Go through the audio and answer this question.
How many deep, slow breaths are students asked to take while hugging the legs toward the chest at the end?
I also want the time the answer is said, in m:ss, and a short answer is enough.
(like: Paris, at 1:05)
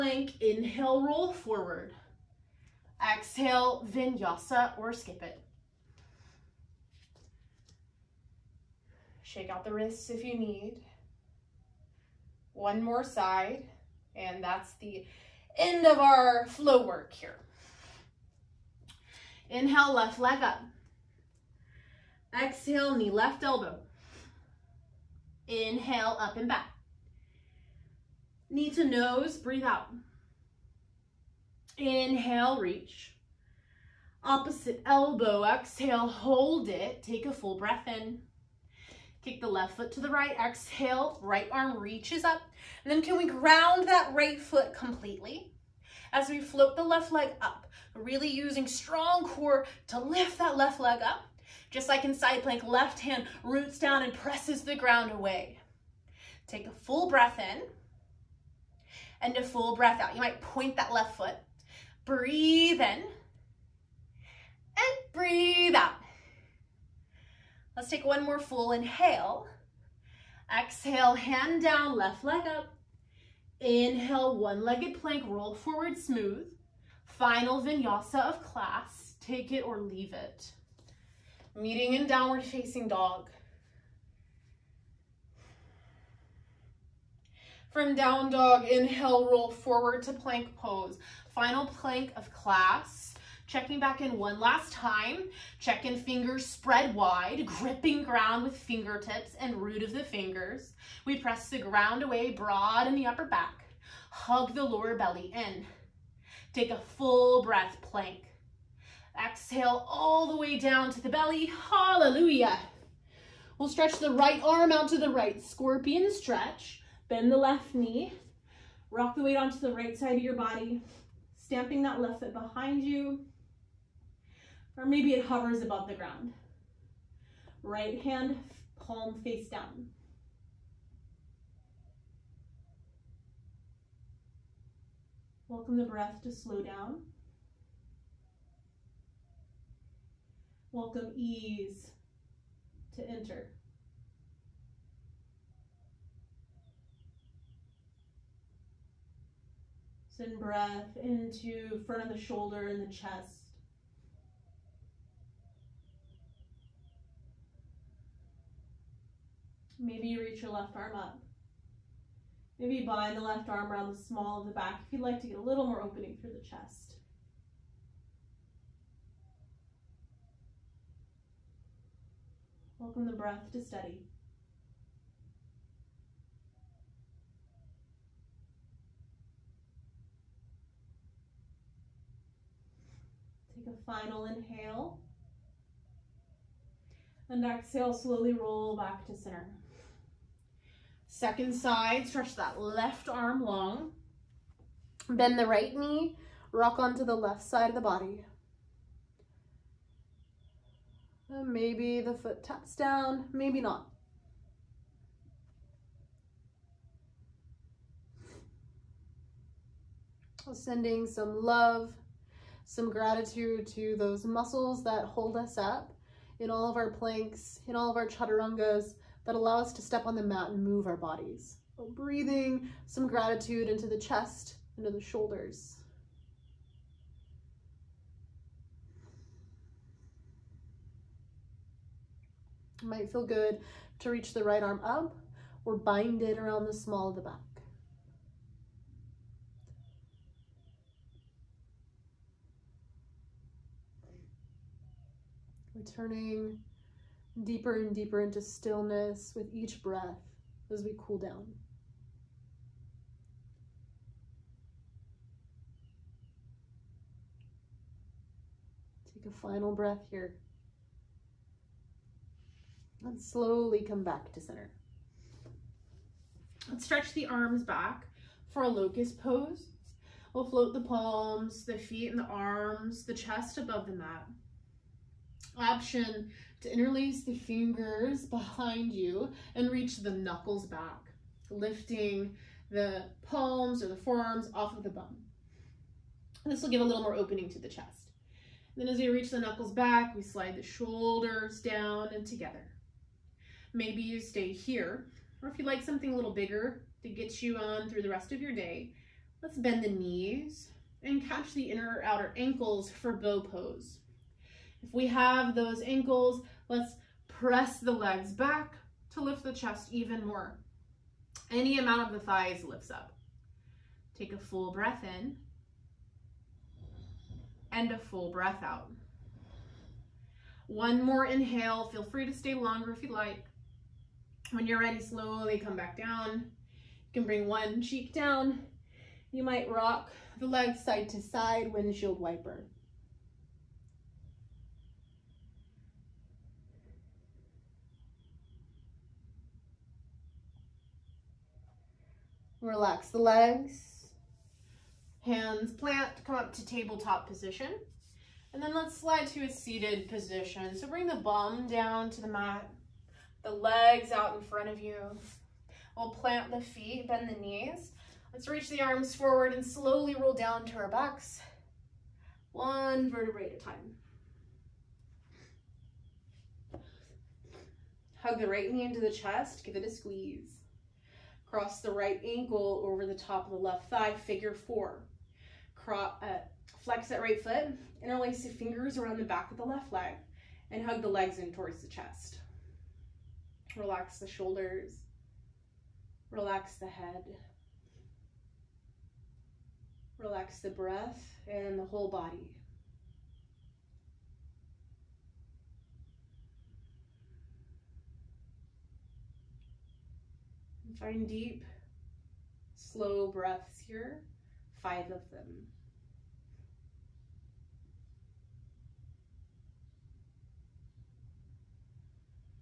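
5, at 6:44.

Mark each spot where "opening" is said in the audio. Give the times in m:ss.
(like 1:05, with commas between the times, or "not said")
2:45, 4:47.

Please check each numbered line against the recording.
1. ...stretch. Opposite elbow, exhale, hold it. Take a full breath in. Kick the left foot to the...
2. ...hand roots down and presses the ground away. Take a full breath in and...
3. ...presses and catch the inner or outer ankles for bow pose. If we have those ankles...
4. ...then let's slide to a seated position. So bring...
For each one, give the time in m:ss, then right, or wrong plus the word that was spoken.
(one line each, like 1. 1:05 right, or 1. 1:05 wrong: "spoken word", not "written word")
1. 0:32 wrong: "reach", not "stretch"
2. 0:52 right
3. 4:59 wrong: "knees", not "presses"
4. 5:48 right.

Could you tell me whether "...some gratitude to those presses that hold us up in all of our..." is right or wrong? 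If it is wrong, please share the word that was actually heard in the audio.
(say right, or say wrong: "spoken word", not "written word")
wrong: "muscles", not "presses".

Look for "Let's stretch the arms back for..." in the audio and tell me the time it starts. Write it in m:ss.
4:26.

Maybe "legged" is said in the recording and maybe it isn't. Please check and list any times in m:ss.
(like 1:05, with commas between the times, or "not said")
1:14.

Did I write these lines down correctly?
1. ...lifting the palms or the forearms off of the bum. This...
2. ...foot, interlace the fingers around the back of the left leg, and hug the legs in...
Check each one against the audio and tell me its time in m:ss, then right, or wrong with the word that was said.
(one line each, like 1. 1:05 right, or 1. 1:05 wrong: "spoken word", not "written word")
1. 4:41 right
2. 6:17 right.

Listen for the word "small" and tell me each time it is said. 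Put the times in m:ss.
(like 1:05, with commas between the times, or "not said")
2:44, 3:56.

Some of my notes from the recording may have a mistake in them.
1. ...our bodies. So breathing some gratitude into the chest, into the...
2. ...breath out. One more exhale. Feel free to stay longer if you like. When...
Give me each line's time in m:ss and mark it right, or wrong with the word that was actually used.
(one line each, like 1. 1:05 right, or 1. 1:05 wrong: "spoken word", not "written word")
1. 3:40 right
2. 5:18 wrong: "inhale", not "exhale".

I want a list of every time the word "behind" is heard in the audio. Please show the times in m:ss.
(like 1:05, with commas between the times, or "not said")
2:02, 4:38.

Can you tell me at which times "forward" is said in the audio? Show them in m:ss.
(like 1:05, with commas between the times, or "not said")
0:01, 1:15, 1:29, 5:59.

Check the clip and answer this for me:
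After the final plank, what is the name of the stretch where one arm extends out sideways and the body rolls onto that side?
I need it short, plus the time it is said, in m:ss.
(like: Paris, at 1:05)
Scorpion stretch, at 1:55.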